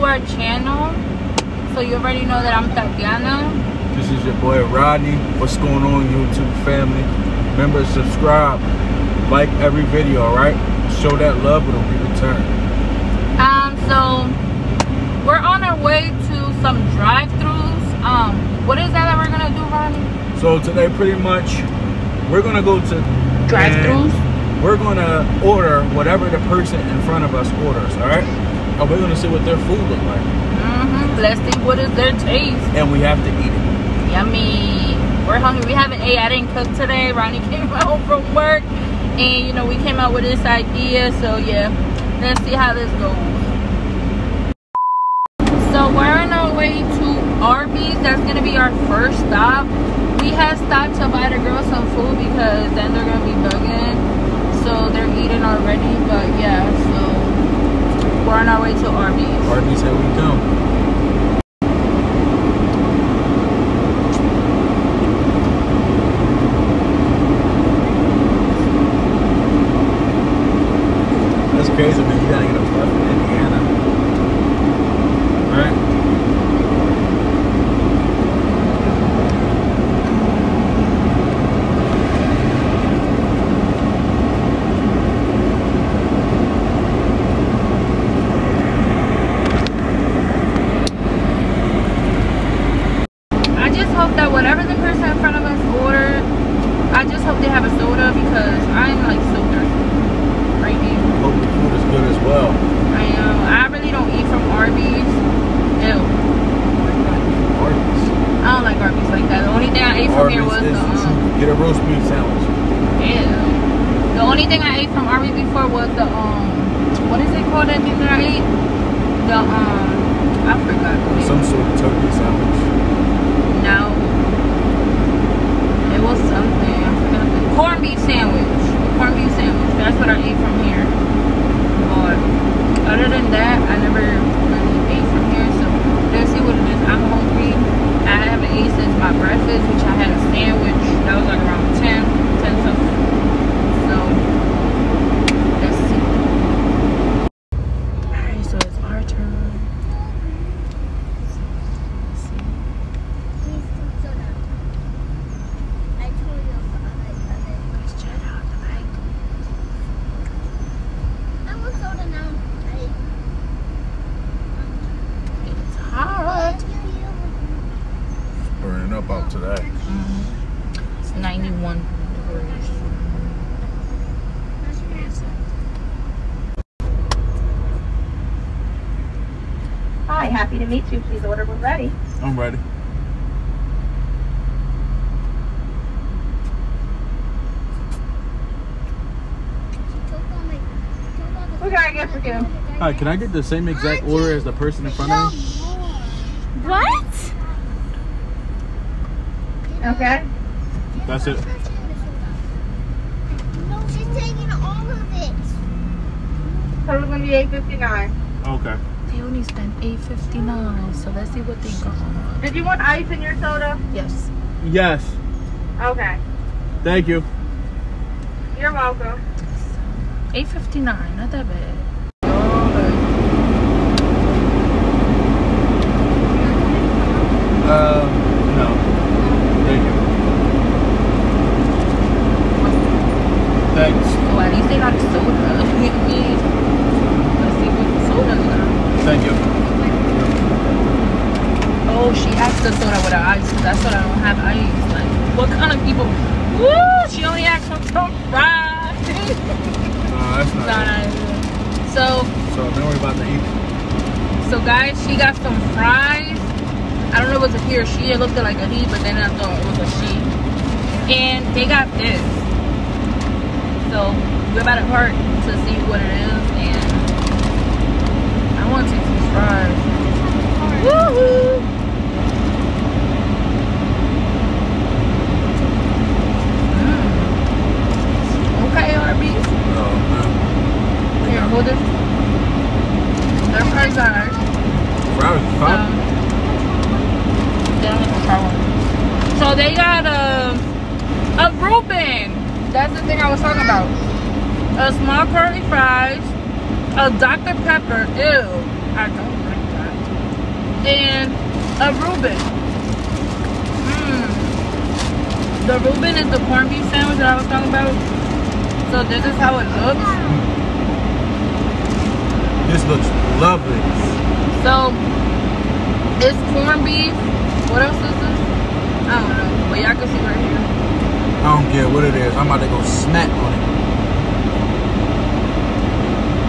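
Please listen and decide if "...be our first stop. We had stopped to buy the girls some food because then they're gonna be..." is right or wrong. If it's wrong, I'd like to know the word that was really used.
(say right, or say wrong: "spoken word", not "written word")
right.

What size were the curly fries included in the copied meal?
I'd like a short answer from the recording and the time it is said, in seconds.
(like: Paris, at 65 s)
Small, at 294 s.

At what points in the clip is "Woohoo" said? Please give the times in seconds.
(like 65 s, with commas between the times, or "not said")
270 s.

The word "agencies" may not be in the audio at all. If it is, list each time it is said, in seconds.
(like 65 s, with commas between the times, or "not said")
not said.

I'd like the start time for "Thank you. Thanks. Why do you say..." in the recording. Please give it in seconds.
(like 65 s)
229 s.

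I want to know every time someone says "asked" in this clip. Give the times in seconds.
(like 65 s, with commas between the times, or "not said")
242 s, 247 s.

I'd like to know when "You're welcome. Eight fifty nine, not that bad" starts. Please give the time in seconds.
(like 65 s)
218 s.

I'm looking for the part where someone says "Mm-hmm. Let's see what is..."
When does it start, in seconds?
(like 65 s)
30 s.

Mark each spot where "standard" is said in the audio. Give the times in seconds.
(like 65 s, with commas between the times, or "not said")
not said.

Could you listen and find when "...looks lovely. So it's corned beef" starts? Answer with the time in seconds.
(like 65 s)
312 s.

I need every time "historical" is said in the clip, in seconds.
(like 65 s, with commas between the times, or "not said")
not said.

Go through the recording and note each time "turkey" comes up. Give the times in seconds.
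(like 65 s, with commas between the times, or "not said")
121 s.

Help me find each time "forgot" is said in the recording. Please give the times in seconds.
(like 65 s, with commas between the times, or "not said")
120 s.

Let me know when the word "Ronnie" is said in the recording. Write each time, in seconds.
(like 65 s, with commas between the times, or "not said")
19 s, 37 s.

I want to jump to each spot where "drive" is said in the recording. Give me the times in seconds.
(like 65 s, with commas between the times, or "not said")
16 s, 23 s.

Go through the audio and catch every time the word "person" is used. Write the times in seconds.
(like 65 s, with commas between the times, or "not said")
26 s, 194 s.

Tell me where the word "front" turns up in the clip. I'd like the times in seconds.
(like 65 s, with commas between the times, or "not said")
27 s, 194 s.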